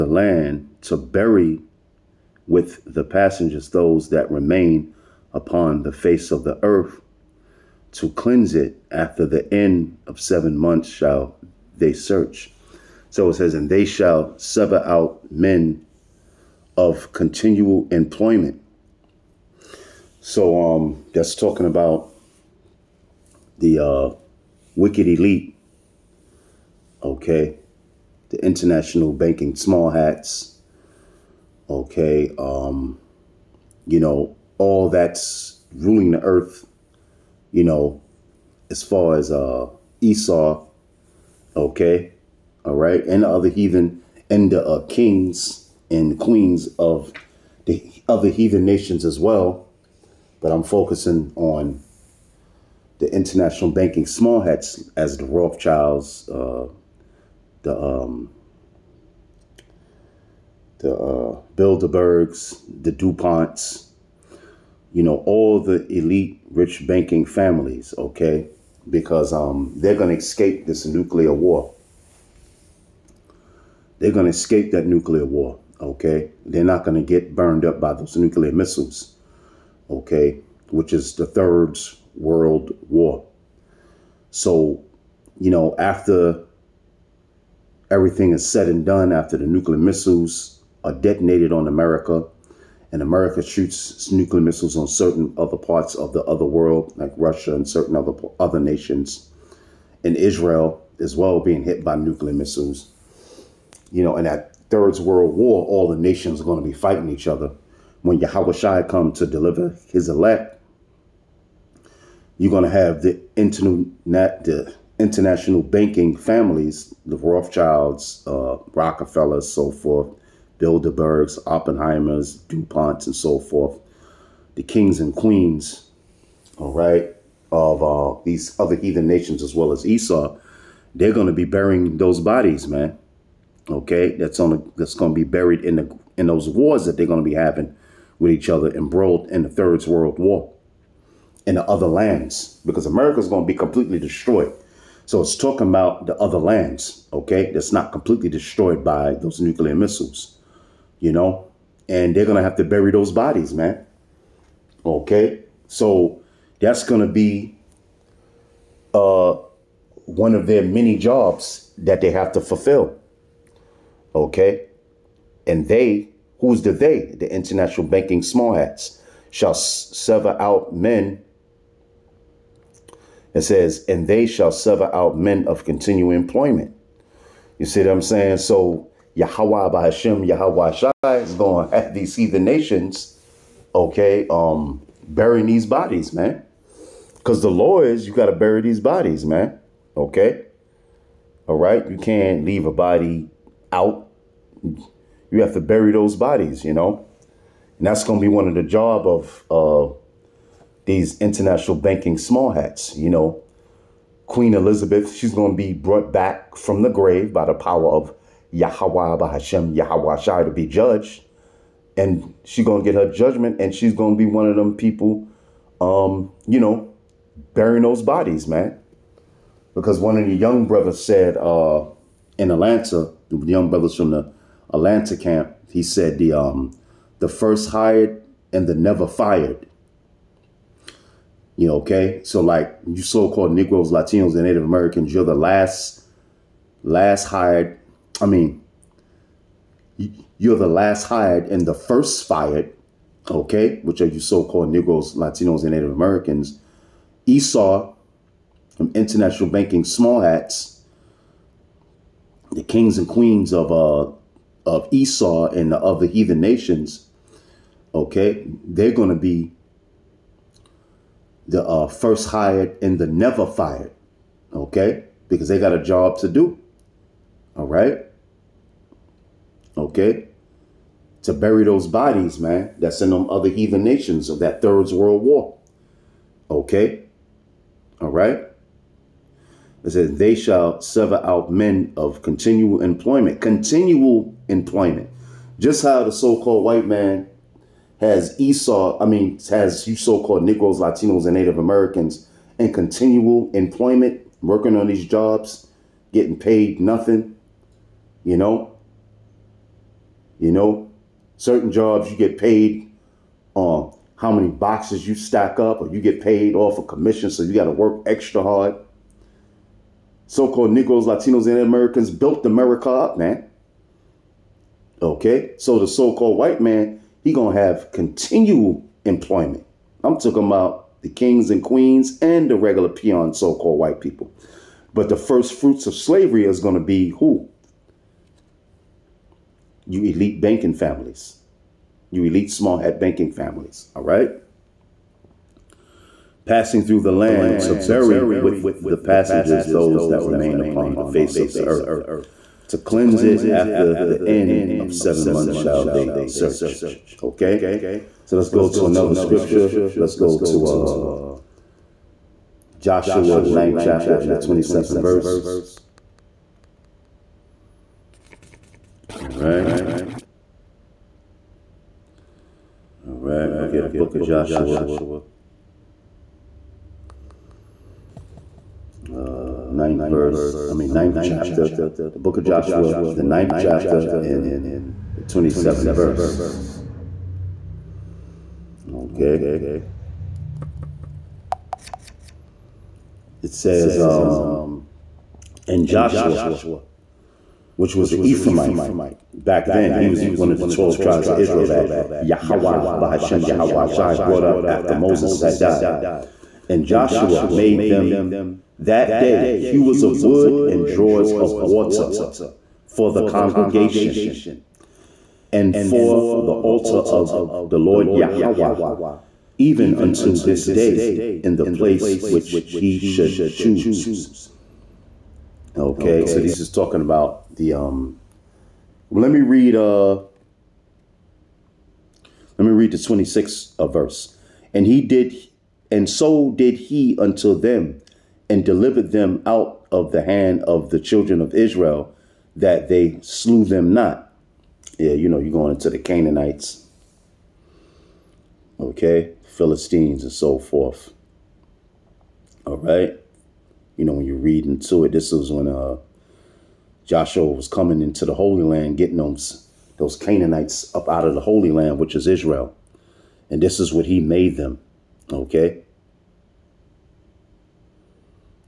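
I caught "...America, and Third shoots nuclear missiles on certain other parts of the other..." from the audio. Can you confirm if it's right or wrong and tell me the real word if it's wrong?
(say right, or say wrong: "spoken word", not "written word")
wrong: "America", not "Third".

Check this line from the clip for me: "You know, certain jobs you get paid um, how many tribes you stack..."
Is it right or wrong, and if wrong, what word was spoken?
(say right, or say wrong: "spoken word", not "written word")
wrong: "boxes", not "tribes".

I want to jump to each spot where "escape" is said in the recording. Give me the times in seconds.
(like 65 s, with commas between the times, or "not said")
70 s, 74 s.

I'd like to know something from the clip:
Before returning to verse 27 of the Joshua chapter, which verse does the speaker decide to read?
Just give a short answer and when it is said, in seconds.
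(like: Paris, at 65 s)
26th, at 422 s.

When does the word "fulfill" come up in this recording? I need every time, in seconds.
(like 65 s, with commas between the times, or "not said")
162 s.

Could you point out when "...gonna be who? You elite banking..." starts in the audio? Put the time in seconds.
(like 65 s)
326 s.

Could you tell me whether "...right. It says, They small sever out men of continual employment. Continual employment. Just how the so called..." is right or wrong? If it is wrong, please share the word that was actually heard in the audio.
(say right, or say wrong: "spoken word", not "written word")
wrong: "shall", not "small".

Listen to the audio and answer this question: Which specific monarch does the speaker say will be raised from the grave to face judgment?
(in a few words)
Queen Elizabeth.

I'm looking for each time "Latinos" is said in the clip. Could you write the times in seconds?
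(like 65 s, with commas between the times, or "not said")
233 s, 245 s, 290 s, 311 s.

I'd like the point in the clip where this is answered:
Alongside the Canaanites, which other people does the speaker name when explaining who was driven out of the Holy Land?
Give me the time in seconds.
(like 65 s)
439 s.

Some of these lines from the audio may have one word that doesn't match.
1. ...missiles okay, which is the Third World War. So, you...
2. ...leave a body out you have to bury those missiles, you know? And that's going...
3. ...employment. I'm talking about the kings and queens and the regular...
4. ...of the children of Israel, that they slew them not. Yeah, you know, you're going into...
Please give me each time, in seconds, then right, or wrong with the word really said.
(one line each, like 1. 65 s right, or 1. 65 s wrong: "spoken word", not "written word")
1. 78 s right
2. 192 s wrong: "bodies", not "missiles"
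3. 319 s right
4. 430 s right.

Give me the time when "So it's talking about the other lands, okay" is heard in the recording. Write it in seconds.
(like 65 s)
145 s.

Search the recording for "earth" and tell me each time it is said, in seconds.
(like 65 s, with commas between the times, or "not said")
6 s, 36 s, 341 s.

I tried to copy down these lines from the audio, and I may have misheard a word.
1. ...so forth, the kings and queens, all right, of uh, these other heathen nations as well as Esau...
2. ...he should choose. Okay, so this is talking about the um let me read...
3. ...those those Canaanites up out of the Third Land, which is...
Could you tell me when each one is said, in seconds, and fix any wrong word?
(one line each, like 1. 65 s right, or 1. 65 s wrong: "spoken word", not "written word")
1. 123 s right
2. 412 s right
3. 449 s wrong: "Holy", not "Third".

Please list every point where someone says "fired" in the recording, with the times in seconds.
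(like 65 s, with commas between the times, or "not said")
229 s, 242 s, 263 s.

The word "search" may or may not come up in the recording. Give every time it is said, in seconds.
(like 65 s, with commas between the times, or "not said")
11 s, 346 s.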